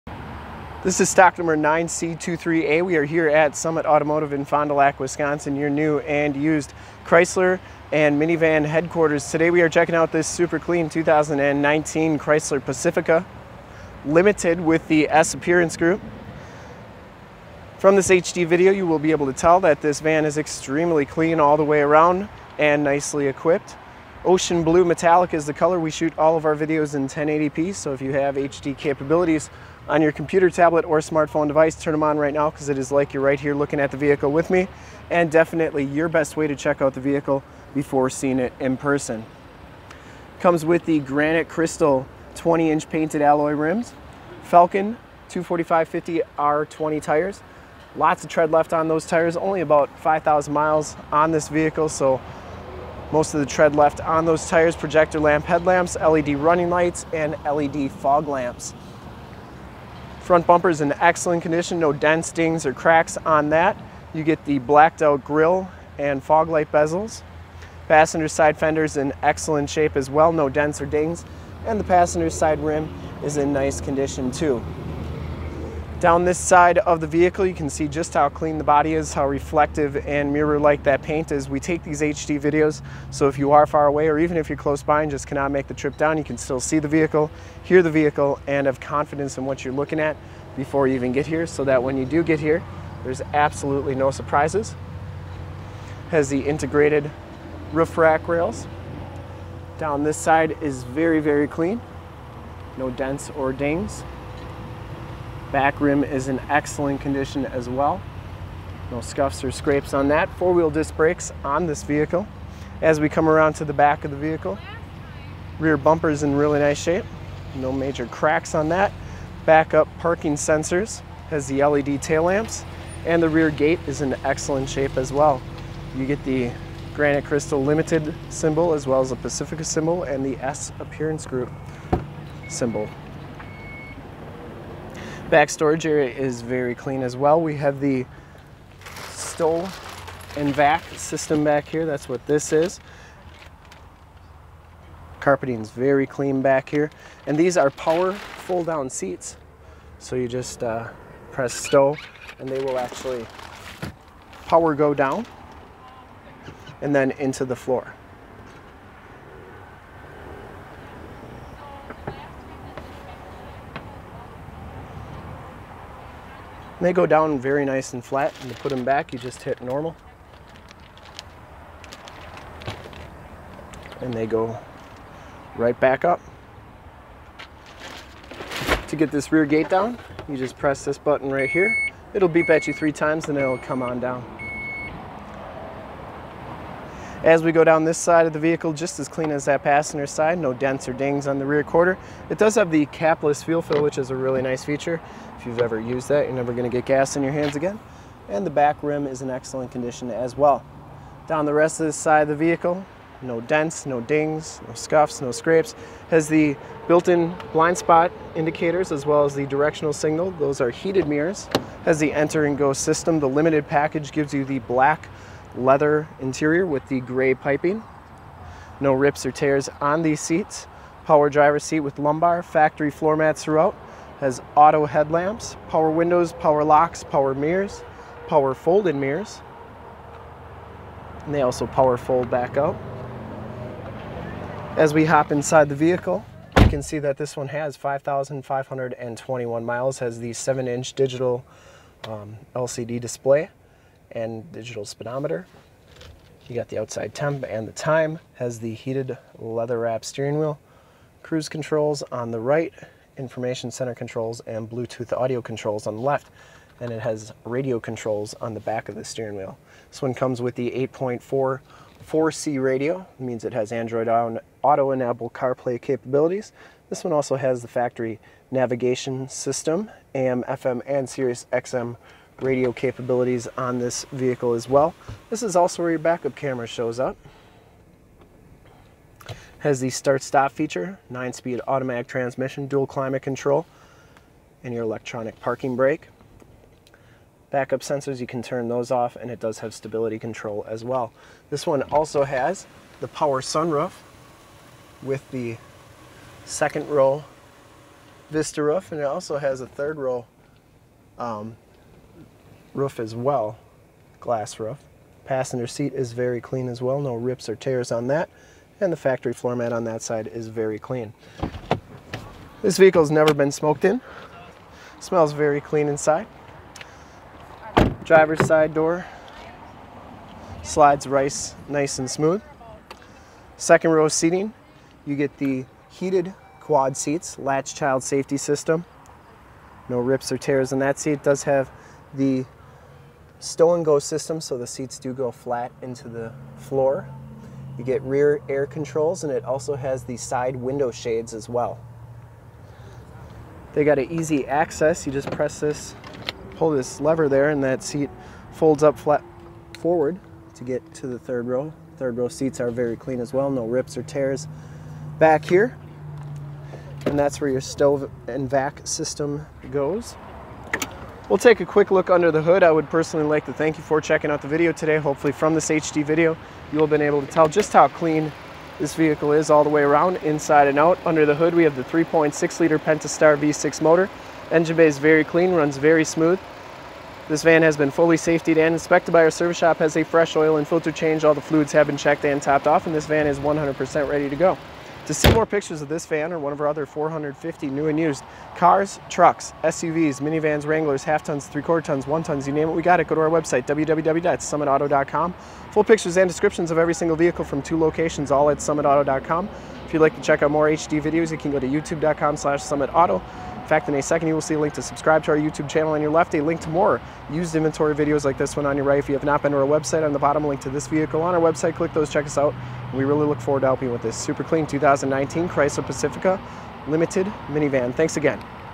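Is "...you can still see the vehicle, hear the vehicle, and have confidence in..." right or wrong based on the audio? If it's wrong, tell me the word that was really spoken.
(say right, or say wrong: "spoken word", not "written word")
right.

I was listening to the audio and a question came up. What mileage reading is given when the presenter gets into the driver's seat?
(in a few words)
5,521.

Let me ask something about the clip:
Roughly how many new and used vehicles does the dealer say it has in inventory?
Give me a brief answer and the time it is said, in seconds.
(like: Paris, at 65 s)
450, at 386 s.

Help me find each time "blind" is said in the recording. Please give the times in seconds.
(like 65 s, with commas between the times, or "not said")
207 s.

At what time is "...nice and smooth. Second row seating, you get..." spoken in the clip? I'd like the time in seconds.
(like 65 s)
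321 s.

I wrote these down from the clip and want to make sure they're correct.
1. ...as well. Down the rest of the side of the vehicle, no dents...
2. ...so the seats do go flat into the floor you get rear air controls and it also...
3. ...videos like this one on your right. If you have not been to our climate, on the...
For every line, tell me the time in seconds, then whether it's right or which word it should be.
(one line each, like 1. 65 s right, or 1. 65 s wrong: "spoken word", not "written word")
1. 200 s right
2. 334 s right
3. 407 s wrong: "website", not "climate".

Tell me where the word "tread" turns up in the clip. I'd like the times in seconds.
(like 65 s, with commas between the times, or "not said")
48 s, 53 s.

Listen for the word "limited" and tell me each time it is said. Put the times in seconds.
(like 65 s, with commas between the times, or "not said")
14 s, 127 s, 213 s, 416 s.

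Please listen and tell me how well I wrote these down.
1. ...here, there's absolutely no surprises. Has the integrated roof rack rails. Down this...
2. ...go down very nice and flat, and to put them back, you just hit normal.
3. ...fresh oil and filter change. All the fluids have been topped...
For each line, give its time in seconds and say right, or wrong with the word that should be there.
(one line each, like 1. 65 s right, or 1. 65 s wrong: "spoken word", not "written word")
1. 92 s right
2. 166 s right
3. 380 s wrong: "checked", not "topped".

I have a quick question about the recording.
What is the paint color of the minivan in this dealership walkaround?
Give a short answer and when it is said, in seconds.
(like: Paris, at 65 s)
Ocean blue metallic, at 24 s.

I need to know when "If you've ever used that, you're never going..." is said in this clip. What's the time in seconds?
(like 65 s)
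195 s.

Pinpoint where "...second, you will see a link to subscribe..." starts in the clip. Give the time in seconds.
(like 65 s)
404 s.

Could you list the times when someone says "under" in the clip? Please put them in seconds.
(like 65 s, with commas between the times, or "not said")
362 s, 371 s.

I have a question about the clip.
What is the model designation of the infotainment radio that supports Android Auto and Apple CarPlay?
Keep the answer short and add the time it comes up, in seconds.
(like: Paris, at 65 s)
8.4 4C, at 260 s.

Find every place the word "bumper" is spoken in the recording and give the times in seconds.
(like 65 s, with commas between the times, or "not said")
60 s, 115 s.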